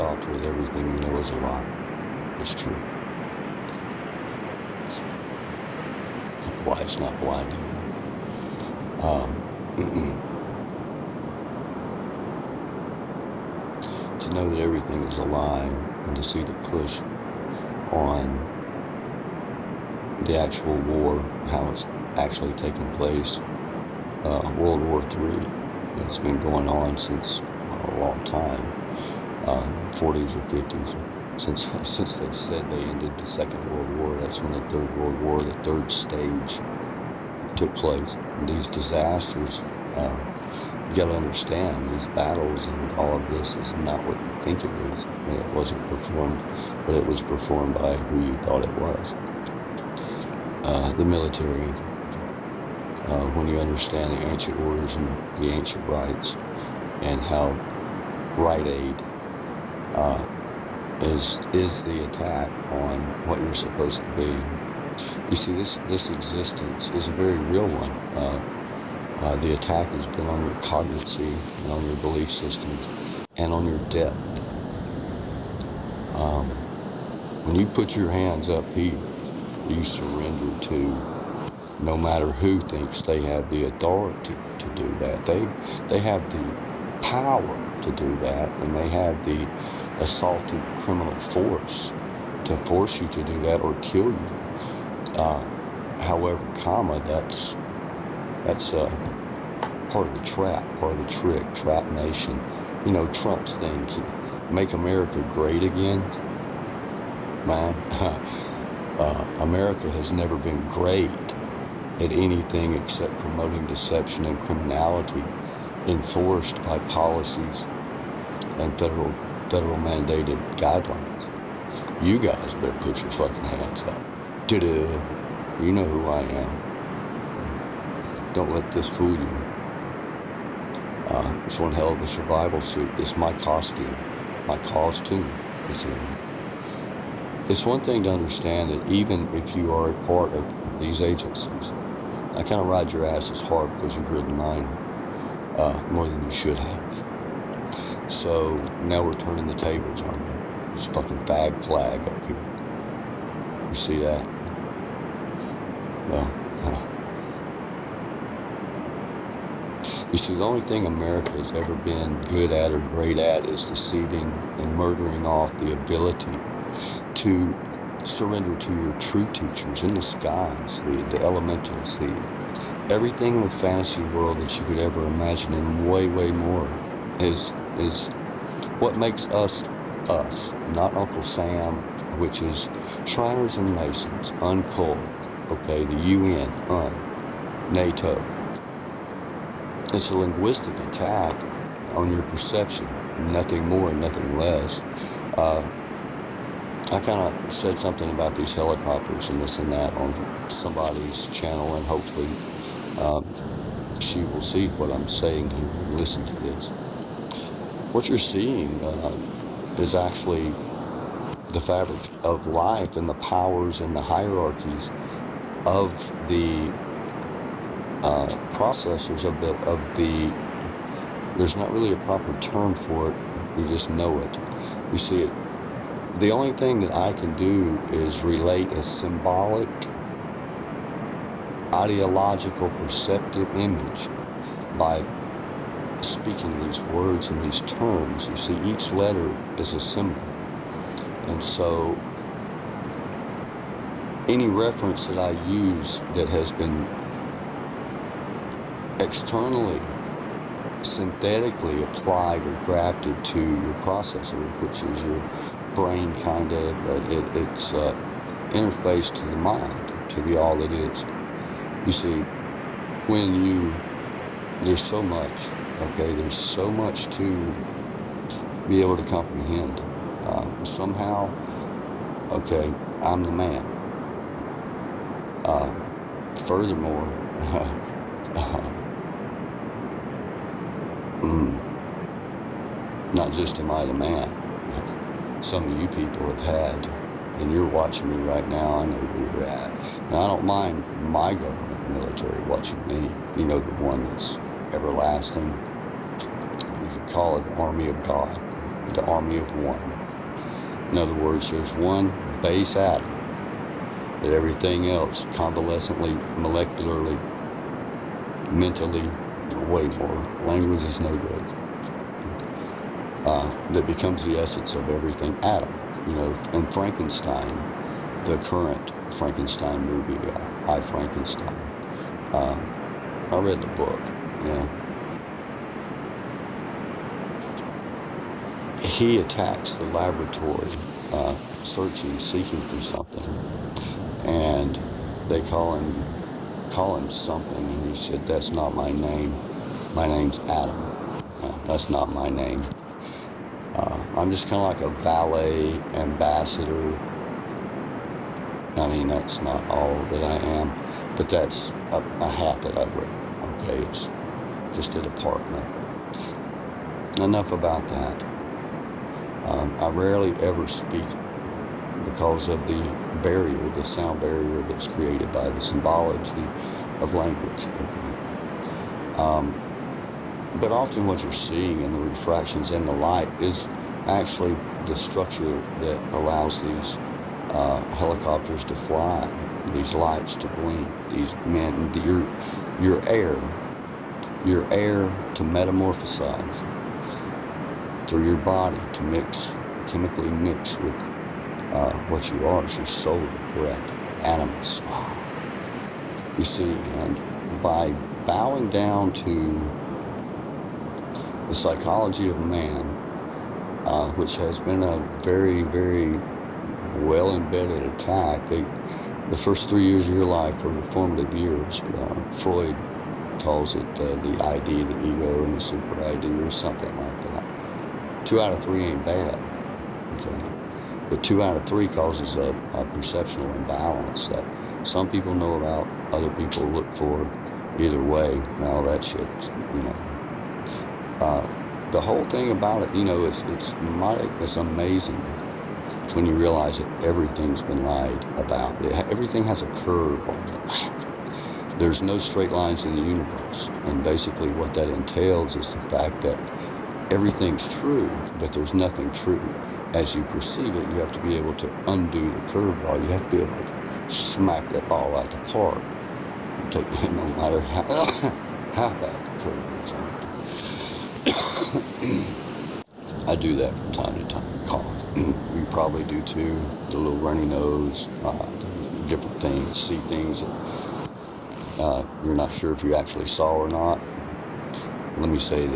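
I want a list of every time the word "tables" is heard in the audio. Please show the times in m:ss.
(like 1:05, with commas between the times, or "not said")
2:29.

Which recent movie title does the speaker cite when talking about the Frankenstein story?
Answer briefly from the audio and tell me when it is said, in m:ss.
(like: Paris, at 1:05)
I Frankenstein, at 5:20.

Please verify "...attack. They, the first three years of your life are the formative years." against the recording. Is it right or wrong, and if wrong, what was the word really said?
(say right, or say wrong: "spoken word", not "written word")
right.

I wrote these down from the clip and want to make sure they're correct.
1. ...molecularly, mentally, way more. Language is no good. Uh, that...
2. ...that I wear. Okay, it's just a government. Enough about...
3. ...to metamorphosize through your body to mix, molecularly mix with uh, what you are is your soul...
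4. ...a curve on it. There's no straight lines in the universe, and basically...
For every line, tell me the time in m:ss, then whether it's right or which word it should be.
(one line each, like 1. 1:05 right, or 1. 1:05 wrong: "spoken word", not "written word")
1. 5:06 right
2. 5:52 wrong: "department", not "government"
3. 6:25 wrong: "chemically", not "molecularly"
4. 7:19 right.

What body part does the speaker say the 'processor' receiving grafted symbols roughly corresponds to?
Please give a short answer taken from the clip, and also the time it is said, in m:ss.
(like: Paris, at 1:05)
Your brain, at 4:15.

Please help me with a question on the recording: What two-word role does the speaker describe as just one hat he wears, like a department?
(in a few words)
Valet ambassador.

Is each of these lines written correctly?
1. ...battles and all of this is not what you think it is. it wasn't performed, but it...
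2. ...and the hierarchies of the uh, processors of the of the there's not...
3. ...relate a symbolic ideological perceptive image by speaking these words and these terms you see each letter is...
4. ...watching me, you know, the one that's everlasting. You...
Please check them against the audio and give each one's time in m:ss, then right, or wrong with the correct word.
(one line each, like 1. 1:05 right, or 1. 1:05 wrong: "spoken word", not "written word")
1. 0:42 right
2. 3:33 right
3. 3:48 right
4. 4:52 right.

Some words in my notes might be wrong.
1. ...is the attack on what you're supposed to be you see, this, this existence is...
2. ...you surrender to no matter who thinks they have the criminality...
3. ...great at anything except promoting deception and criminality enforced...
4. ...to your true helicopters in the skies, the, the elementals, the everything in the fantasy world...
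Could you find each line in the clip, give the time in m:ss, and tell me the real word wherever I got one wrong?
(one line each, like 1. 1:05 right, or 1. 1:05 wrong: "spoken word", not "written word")
1. 1:01 right
2. 1:19 wrong: "authority", not "criminality"
3. 1:50 right
4. 2:48 wrong: "teachers", not "helicopters".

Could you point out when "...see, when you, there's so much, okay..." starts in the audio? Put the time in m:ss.
4:21.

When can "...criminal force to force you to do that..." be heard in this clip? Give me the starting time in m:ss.
1:30.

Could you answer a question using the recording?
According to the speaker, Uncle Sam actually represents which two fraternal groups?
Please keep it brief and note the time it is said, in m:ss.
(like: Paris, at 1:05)
Shriners and Masons, at 3:03.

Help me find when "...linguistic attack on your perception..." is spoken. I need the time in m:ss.
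3:10.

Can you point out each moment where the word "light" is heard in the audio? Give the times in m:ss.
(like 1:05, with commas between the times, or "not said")
6:12, 6:19.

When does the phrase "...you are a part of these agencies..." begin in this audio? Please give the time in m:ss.
2:19.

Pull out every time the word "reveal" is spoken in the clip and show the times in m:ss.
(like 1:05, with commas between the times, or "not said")
not said.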